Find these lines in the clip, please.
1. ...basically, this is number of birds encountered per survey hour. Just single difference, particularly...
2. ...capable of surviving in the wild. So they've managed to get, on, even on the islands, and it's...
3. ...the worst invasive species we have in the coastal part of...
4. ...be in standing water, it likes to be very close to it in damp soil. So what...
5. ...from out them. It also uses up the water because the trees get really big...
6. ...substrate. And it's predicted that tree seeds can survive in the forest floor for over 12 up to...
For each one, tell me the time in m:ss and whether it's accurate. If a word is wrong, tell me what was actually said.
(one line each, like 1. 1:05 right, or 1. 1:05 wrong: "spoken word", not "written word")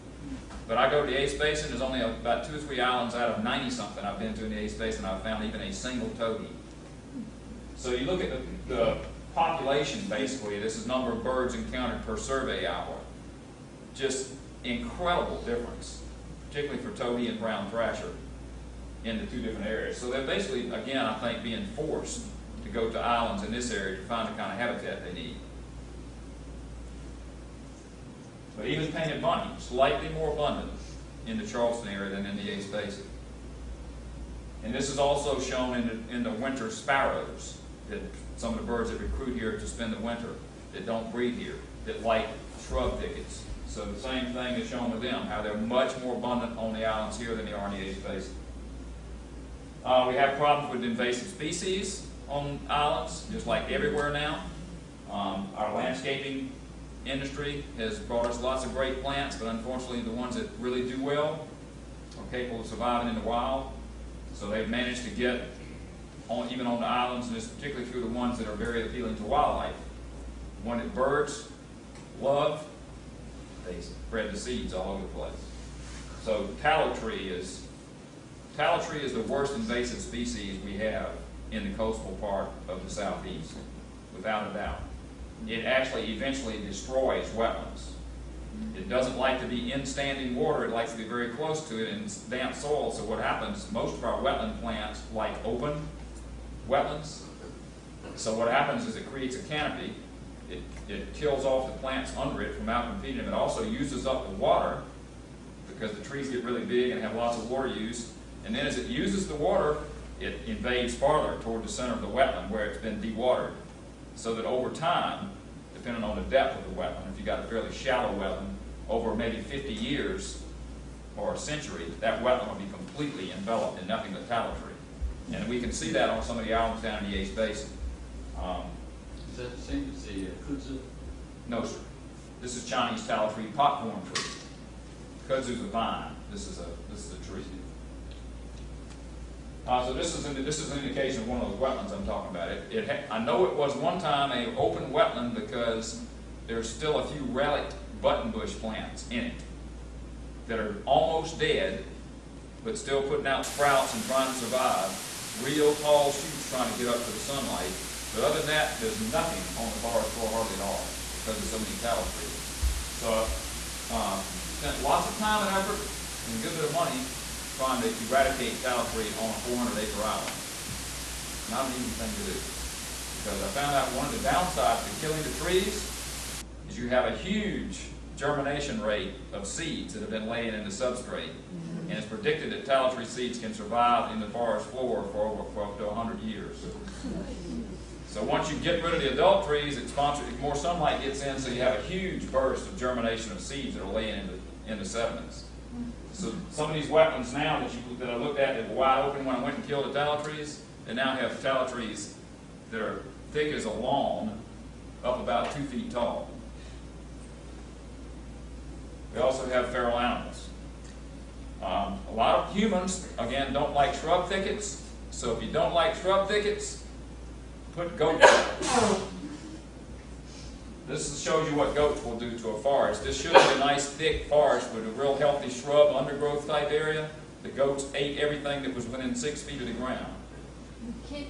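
1. 0:10 wrong: "incredible", not "single"
2. 1:02 right
3. 1:19 right
4. 1:29 right
5. 1:42 right
6. 3:00 right.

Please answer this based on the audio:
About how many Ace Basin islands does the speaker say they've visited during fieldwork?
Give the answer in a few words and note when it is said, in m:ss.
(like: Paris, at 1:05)
90 something, at 0:03.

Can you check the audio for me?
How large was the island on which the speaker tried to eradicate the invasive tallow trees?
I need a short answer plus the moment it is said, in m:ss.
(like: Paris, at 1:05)
400 acres, at 2:49.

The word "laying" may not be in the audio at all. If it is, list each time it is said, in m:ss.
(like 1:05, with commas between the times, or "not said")
3:00, 3:13.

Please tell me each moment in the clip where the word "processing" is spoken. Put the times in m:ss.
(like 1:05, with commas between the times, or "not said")
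not said.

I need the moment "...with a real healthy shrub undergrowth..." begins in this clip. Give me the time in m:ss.
3:44.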